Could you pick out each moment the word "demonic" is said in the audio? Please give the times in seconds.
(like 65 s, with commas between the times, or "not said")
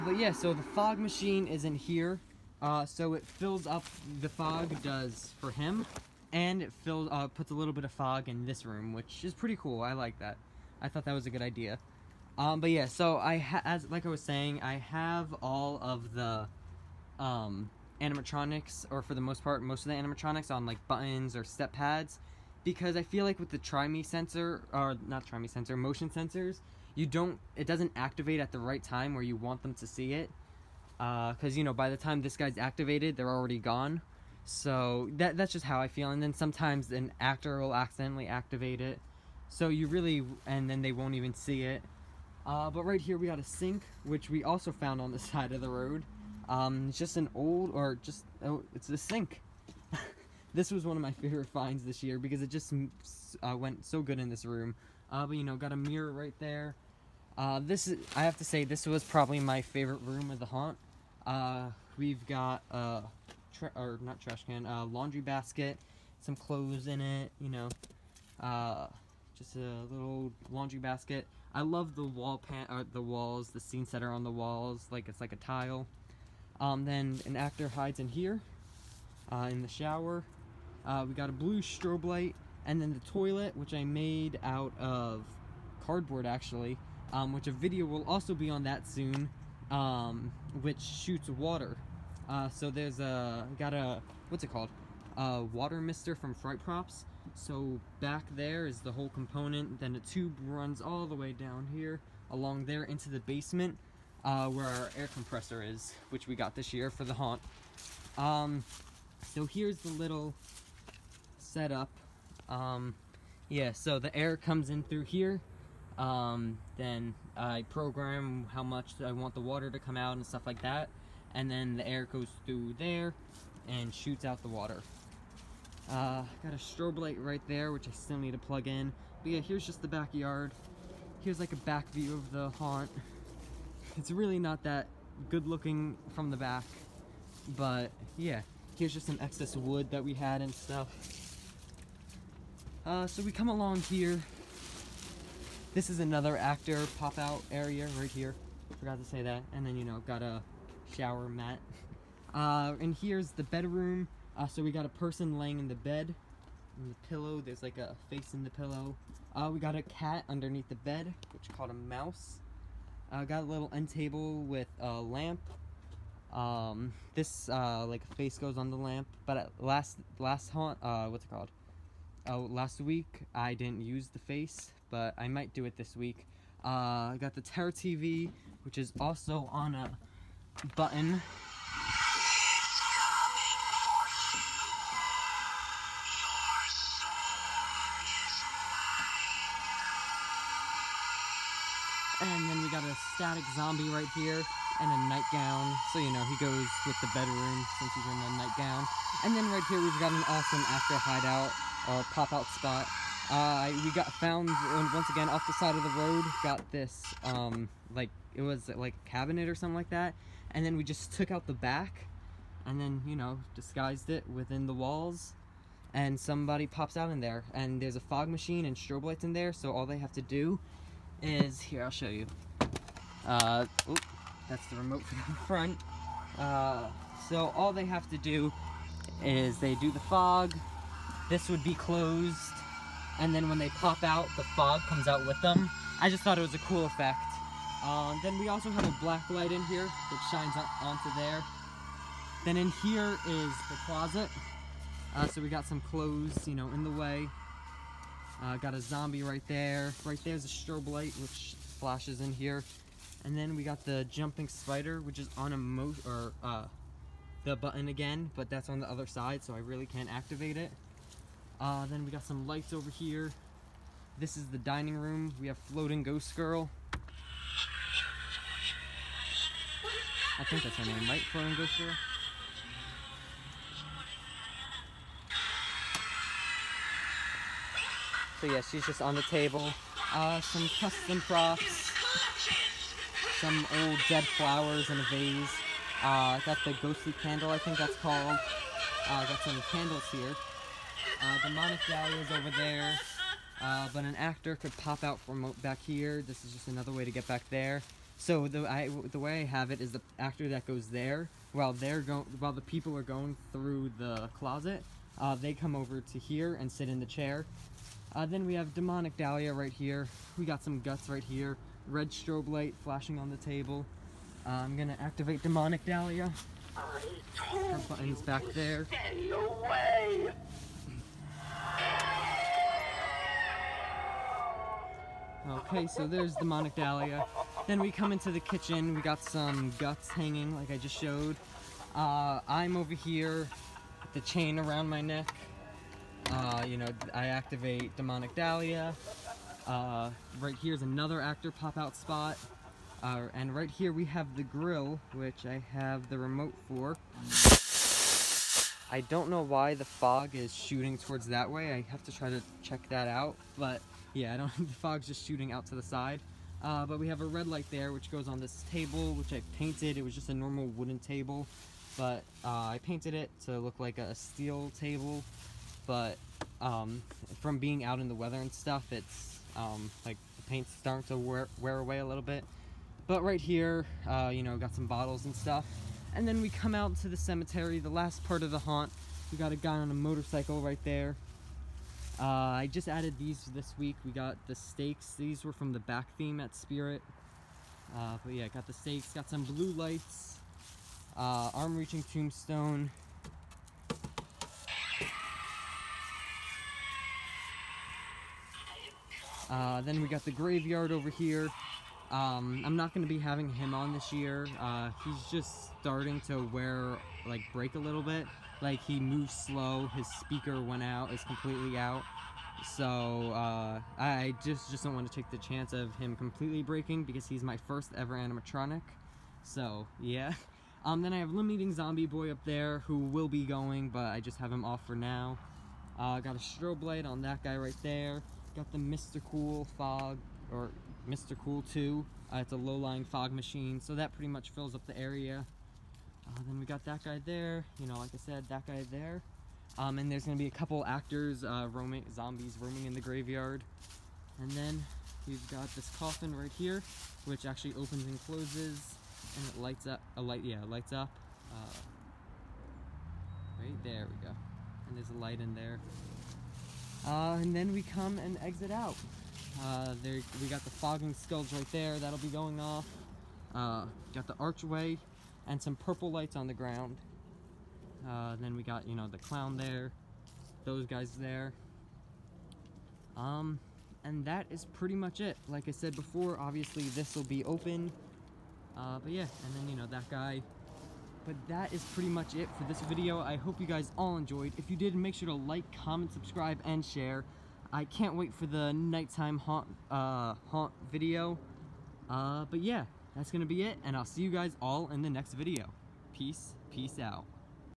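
291 s, 308 s, 315 s, 326 s, 337 s.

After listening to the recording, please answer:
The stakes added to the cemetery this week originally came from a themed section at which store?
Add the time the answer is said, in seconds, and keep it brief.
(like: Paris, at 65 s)
Spirit, at 386 s.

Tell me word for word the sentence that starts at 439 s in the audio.
Um, and there's going to be a couple actors, uh, roaming, zombies roaming in the graveyard.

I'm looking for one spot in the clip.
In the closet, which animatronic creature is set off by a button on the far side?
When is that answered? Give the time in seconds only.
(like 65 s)
254 s.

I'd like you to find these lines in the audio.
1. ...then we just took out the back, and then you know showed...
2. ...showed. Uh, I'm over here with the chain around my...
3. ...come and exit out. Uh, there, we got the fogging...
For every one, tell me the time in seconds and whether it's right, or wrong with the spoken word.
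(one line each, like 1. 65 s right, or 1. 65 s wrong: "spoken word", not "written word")
1. 210 s wrong: "disguised", not "showed"
2. 330 s right
3. 457 s right.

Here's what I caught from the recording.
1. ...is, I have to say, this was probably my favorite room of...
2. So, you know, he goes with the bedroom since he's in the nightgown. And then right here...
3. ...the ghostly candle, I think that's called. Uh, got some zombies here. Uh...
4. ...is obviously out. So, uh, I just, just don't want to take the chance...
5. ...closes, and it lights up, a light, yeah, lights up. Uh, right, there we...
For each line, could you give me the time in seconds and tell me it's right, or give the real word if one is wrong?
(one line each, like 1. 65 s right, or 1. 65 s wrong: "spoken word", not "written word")
1. 57 s right
2. 195 s right
3. 286 s wrong: "candles", not "zombies"
4. 411 s wrong: "completely", not "obviously"
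5. 448 s right.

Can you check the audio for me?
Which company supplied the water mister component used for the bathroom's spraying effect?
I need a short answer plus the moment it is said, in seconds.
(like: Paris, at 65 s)
Fright Props, at 96 s.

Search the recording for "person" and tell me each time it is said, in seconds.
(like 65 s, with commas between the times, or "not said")
154 s.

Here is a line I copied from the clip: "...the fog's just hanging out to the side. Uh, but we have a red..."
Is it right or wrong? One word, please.
wrong.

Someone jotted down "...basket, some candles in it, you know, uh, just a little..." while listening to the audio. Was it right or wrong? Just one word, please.
wrong.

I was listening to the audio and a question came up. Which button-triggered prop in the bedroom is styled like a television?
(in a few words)
Terror TV.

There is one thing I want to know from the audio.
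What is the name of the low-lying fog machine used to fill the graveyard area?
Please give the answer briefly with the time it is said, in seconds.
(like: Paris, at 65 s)
Mr. Cool 2, at 431 s.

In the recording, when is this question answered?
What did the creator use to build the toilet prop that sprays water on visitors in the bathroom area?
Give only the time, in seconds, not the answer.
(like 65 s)
85 s.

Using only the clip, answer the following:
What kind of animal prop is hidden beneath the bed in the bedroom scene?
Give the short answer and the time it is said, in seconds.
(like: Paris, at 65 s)
A cat, at 159 s.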